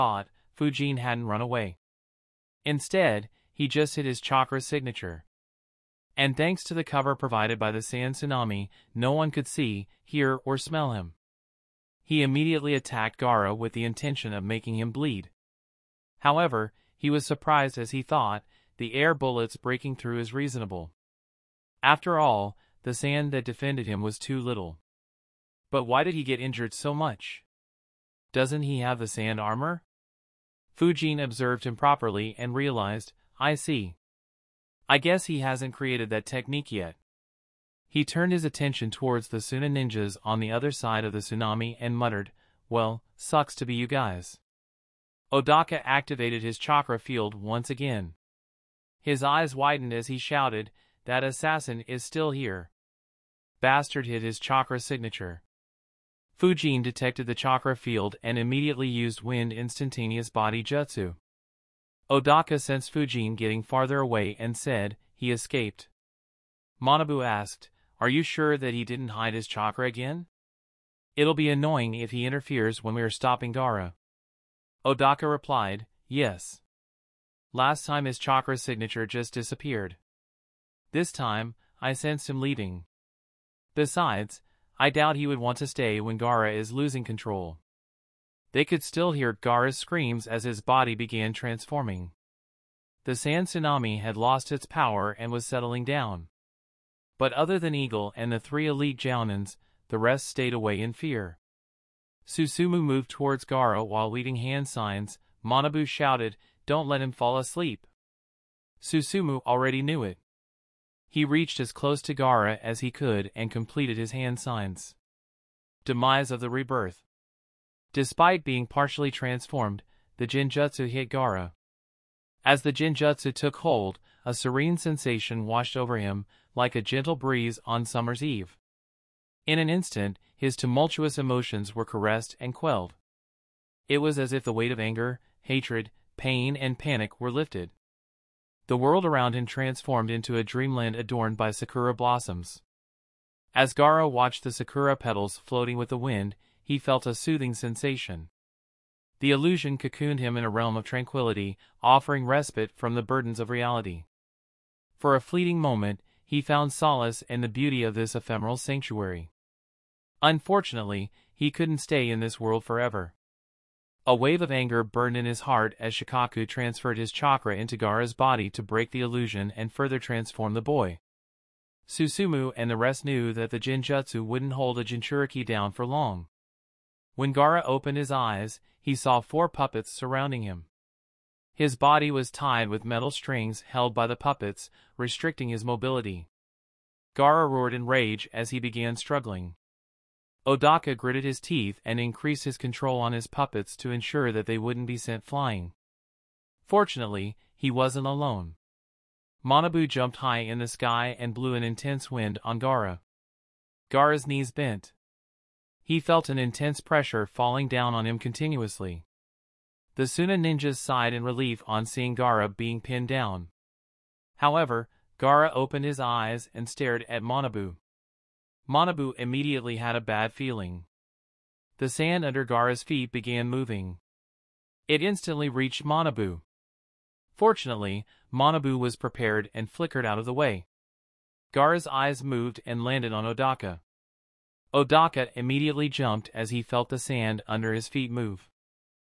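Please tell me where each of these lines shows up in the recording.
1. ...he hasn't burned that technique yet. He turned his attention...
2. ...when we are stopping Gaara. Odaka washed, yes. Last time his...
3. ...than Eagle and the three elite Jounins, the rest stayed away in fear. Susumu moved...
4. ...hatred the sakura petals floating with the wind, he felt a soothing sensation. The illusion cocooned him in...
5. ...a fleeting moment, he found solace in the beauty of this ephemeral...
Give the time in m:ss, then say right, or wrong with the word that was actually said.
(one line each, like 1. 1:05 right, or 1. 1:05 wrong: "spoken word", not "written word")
1. 0:35 wrong: "created", not "burned"
2. 1:12 wrong: "replied", not "washed"
3. 1:37 right
4. 2:24 wrong: "watched", not "hatred"
5. 2:35 right.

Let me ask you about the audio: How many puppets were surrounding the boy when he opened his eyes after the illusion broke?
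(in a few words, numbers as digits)
4.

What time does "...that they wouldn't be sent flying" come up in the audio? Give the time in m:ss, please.
3:14.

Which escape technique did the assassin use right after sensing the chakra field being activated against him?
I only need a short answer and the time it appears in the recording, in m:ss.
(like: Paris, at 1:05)
Wind instantaneous body jutsu, at 0:59.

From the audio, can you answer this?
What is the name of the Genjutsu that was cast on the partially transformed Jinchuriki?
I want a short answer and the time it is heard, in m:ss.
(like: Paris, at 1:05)
Demise of the Rebirth, at 1:55.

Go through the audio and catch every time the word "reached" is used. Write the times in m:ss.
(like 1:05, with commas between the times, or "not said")
1:51, 3:45.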